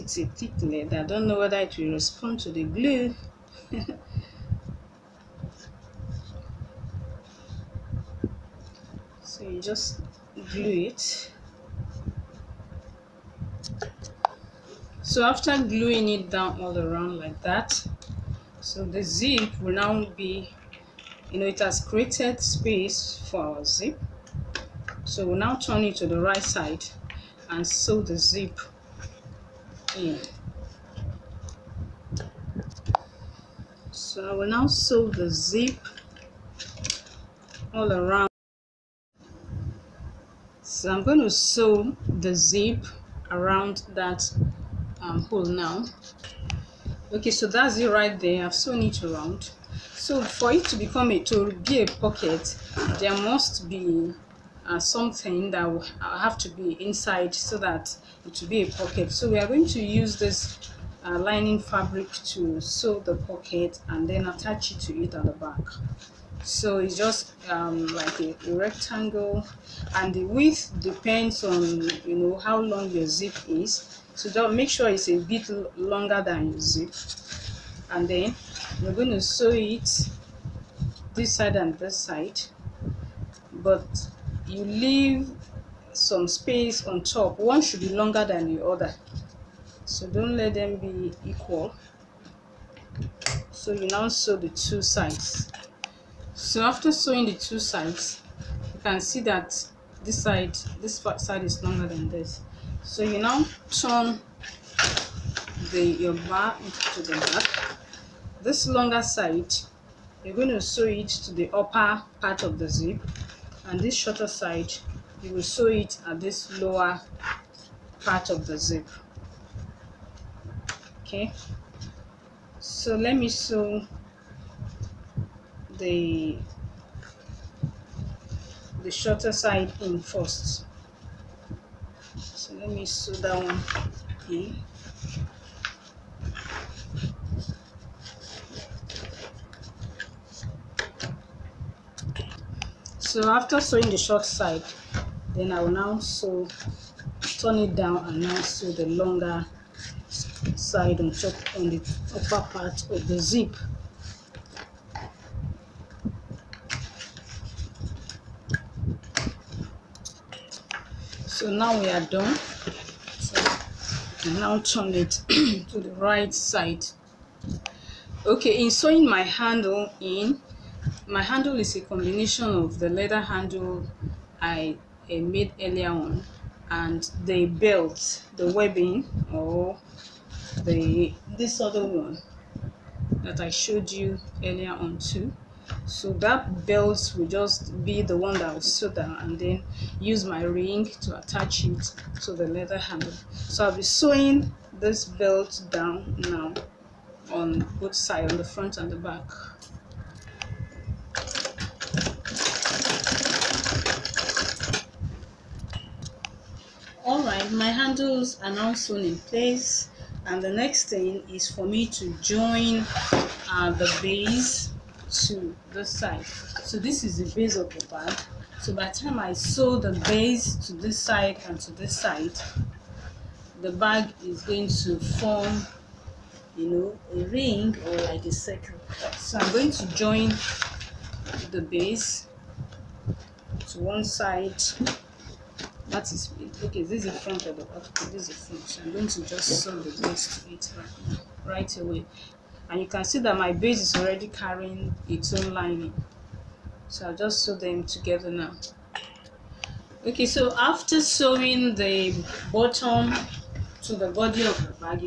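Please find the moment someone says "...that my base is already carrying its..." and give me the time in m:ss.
4:03.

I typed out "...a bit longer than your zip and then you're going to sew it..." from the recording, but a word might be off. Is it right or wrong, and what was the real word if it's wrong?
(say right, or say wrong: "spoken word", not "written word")
right.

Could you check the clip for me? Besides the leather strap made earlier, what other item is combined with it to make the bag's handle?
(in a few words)
webbing.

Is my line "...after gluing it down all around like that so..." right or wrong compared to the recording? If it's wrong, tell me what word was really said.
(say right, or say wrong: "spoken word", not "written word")
right.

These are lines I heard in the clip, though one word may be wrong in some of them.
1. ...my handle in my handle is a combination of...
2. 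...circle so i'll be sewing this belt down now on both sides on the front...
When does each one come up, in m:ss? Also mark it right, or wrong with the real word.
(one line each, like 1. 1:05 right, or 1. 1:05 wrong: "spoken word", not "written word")
1. 2:49 right
2. 3:12 wrong: "handle", not "circle".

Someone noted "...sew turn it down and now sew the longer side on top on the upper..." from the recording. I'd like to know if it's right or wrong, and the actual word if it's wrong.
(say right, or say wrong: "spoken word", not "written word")
right.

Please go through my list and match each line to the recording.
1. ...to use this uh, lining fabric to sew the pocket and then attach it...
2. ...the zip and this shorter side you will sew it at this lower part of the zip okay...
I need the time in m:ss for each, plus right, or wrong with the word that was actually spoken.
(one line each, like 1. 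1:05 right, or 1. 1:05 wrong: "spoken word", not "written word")
1. 0:59 right
2. 1:52 right.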